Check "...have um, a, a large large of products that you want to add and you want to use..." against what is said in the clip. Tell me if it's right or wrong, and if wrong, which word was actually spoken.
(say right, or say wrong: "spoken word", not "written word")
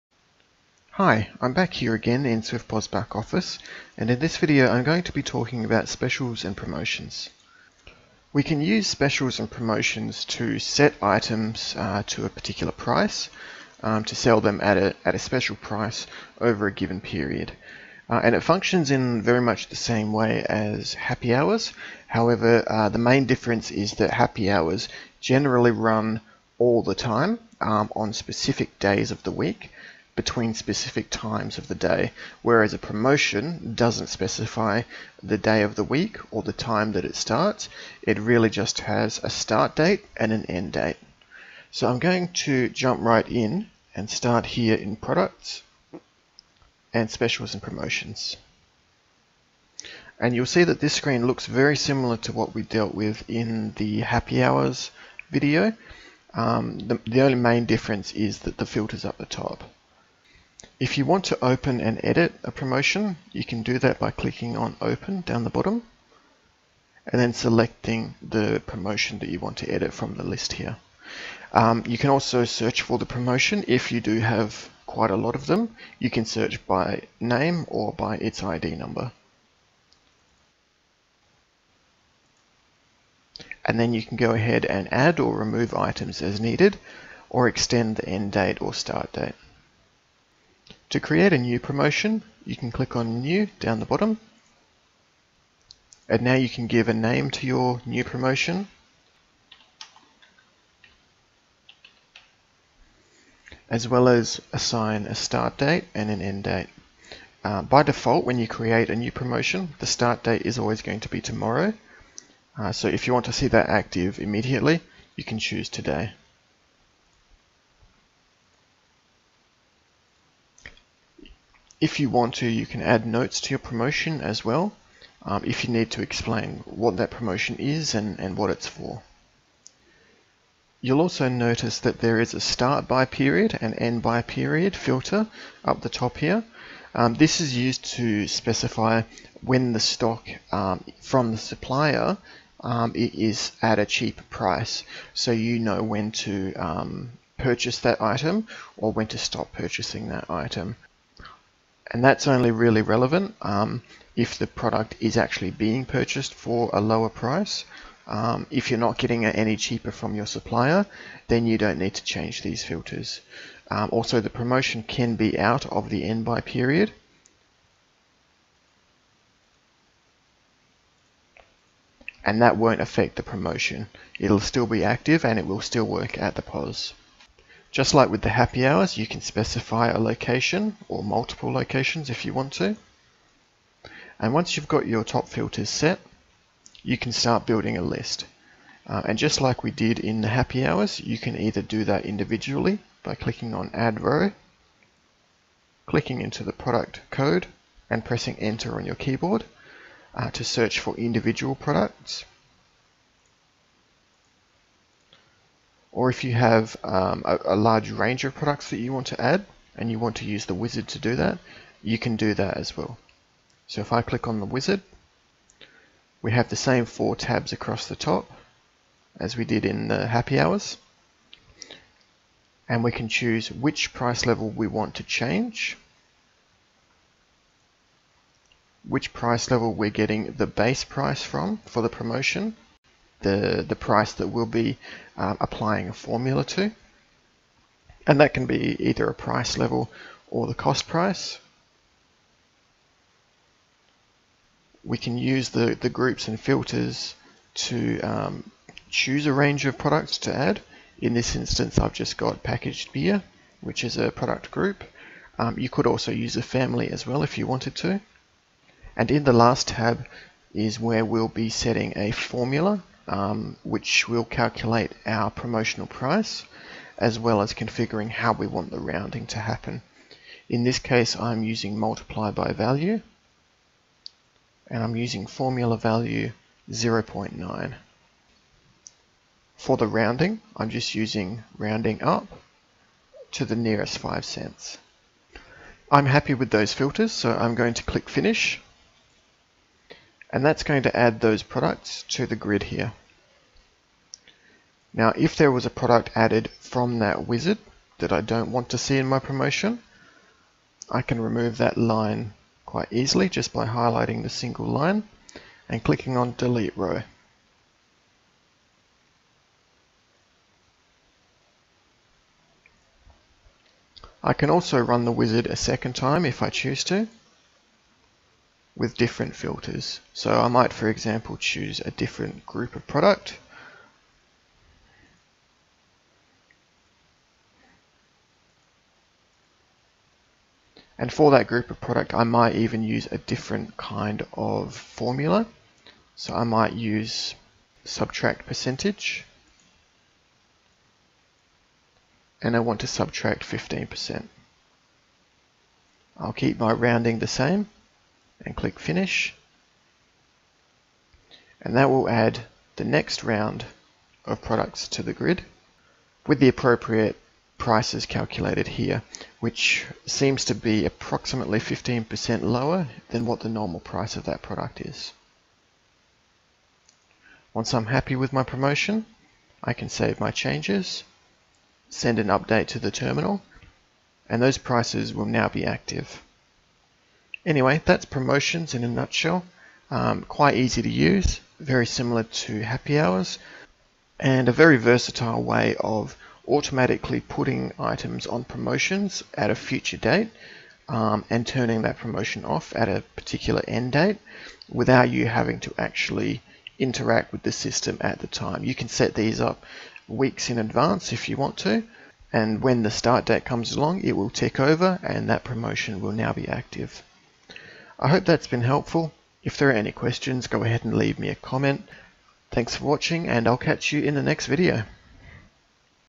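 wrong: "range", not "large".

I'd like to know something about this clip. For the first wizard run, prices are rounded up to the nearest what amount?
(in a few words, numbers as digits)
5 cents.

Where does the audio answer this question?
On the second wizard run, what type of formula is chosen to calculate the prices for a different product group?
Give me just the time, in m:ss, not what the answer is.
5:37.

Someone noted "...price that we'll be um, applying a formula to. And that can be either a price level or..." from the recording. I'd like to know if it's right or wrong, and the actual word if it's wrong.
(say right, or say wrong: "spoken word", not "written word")
right.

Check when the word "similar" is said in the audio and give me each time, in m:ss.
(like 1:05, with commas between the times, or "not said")
0:51, 6:21.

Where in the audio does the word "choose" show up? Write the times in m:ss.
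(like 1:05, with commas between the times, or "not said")
1:55, 3:43, 4:08, 5:16, 5:21.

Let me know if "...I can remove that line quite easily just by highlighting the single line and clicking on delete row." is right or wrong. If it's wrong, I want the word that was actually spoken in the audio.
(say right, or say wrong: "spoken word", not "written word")
right.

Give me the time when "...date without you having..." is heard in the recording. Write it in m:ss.
6:33.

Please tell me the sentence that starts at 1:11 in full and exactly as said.
Um, you can also search for the promotion if you do have quite a lot of them.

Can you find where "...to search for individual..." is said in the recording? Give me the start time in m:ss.
3:20.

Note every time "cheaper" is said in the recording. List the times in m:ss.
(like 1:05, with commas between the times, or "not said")
2:23, 2:39.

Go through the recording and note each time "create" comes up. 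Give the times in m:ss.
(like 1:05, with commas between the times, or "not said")
1:30, 1:48.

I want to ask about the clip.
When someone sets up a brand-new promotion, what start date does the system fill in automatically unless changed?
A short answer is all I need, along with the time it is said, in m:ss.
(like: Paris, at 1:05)
tomorrow, at 1:51.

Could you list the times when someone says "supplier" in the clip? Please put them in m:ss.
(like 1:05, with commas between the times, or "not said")
2:21, 2:40.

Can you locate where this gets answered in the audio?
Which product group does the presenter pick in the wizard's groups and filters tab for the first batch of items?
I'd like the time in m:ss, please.
4:12.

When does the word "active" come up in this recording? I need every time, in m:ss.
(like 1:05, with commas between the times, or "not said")
1:53, 2:54, 6:15, 6:46.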